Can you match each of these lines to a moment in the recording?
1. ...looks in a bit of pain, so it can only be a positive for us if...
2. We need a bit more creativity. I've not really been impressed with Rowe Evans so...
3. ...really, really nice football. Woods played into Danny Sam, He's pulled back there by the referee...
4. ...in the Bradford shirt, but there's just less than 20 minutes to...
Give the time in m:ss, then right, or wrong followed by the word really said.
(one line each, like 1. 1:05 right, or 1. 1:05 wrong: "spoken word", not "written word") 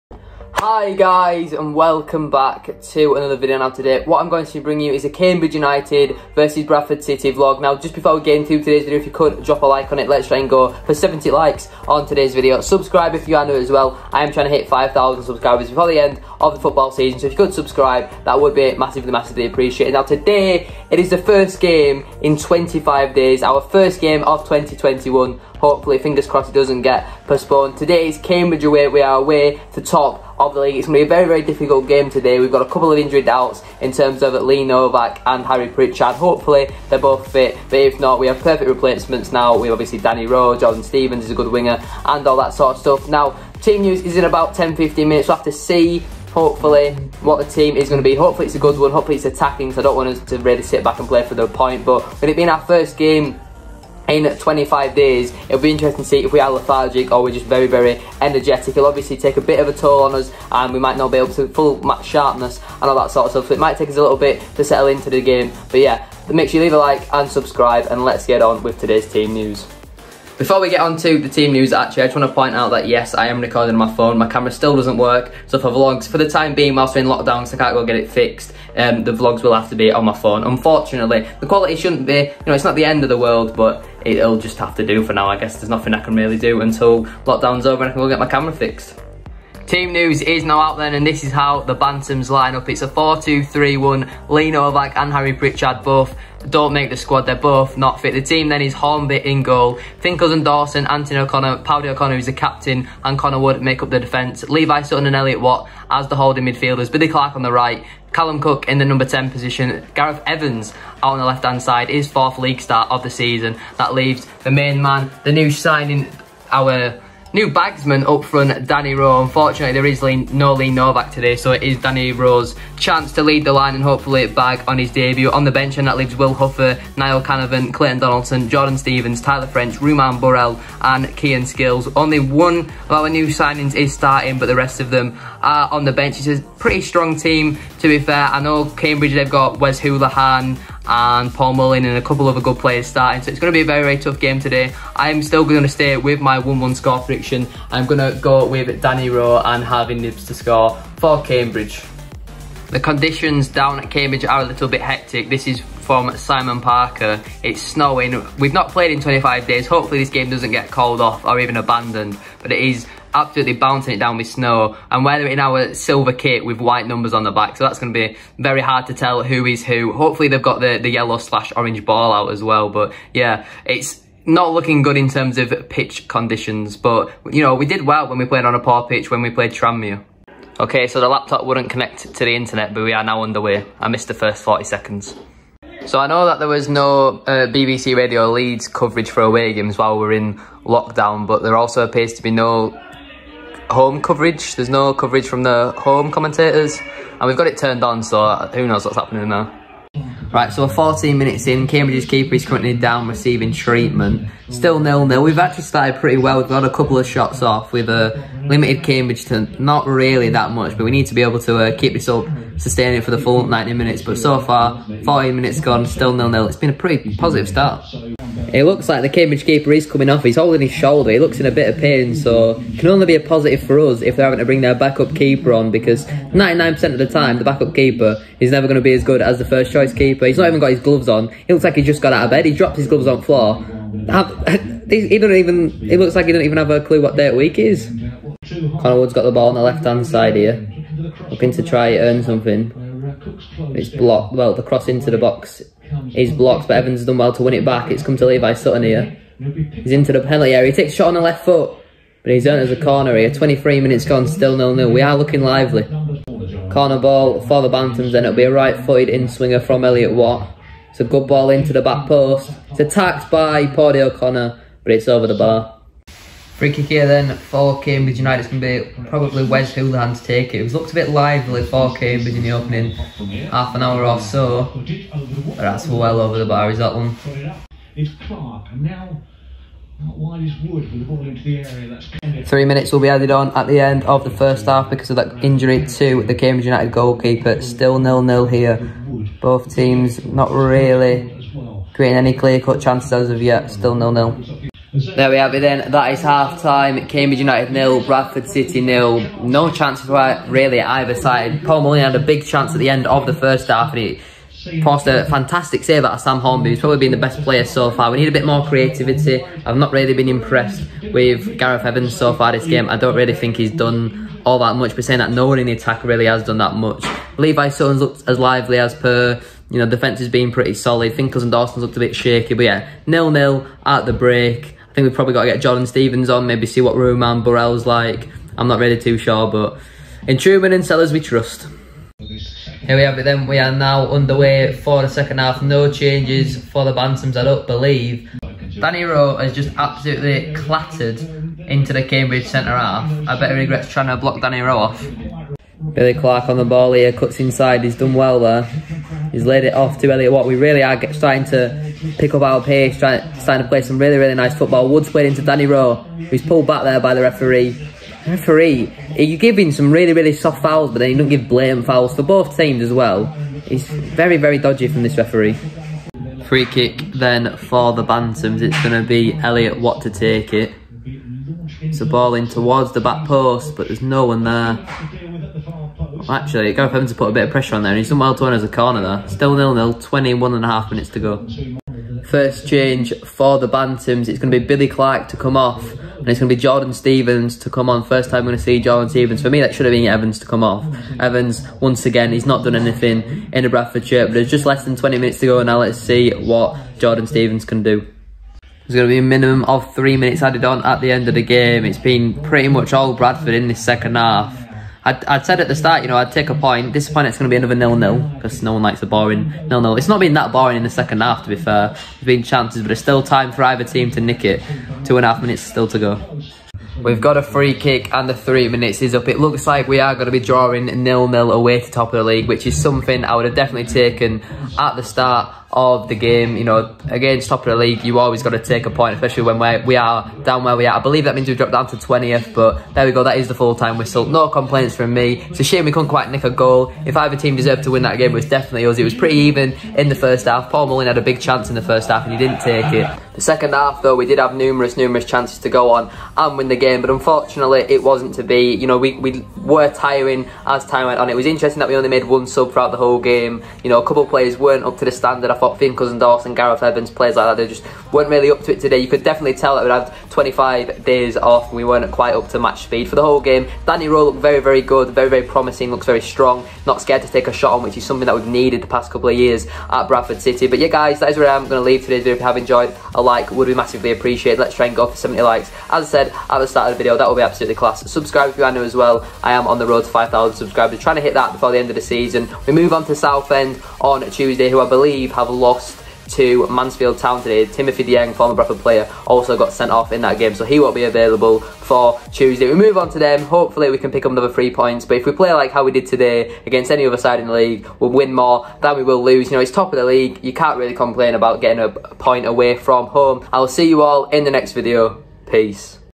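1. 3:41 right
2. 5:08 wrong: "Gareth", not "Rowe"
3. 5:53 wrong: "Rowe", not "Sam"
4. 6:33 right.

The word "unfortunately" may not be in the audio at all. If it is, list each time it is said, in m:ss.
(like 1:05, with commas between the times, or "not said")
1:20, 1:59, 7:27.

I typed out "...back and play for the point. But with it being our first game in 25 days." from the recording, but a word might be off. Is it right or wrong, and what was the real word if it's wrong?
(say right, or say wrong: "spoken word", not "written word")
right.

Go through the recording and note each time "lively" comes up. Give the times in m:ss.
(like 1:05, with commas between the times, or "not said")
4:15, 4:31, 5:18.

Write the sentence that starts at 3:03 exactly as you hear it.
I missed the first 40 seconds.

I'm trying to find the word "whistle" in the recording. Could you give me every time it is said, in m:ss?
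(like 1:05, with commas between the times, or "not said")
7:13.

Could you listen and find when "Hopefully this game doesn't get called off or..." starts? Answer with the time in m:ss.
2:39.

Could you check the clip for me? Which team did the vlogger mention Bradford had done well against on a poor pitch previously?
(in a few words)
Tranmere.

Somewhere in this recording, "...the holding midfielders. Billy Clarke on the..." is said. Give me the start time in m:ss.
1:46.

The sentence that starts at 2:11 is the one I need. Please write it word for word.
Only one of our new signings is starting, but the rest of them are on the bench.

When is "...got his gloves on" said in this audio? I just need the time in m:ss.
3:50.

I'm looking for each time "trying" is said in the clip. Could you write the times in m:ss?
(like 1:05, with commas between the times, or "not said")
0:14, 5:43, 5:52, 8:00.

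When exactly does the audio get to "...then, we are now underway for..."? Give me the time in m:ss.
5:33.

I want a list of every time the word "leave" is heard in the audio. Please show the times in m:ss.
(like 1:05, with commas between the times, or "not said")
1:06, 1:53, 2:05, 7:51.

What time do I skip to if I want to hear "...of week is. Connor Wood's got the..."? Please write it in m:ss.
3:57.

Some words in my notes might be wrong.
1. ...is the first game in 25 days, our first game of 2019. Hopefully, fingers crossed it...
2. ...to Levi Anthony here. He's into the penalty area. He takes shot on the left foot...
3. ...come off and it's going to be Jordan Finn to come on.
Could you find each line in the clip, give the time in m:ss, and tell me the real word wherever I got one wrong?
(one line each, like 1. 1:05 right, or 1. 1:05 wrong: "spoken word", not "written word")
1. 0:20 wrong: "2021", not "2019"
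2. 4:08 wrong: "Sutton", not "Anthony"
3. 6:25 wrong: "Stevens", not "Finn".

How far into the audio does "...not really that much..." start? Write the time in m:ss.
3:29.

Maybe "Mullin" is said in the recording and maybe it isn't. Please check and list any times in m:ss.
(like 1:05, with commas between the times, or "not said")
2:21, 5:01, 7:20.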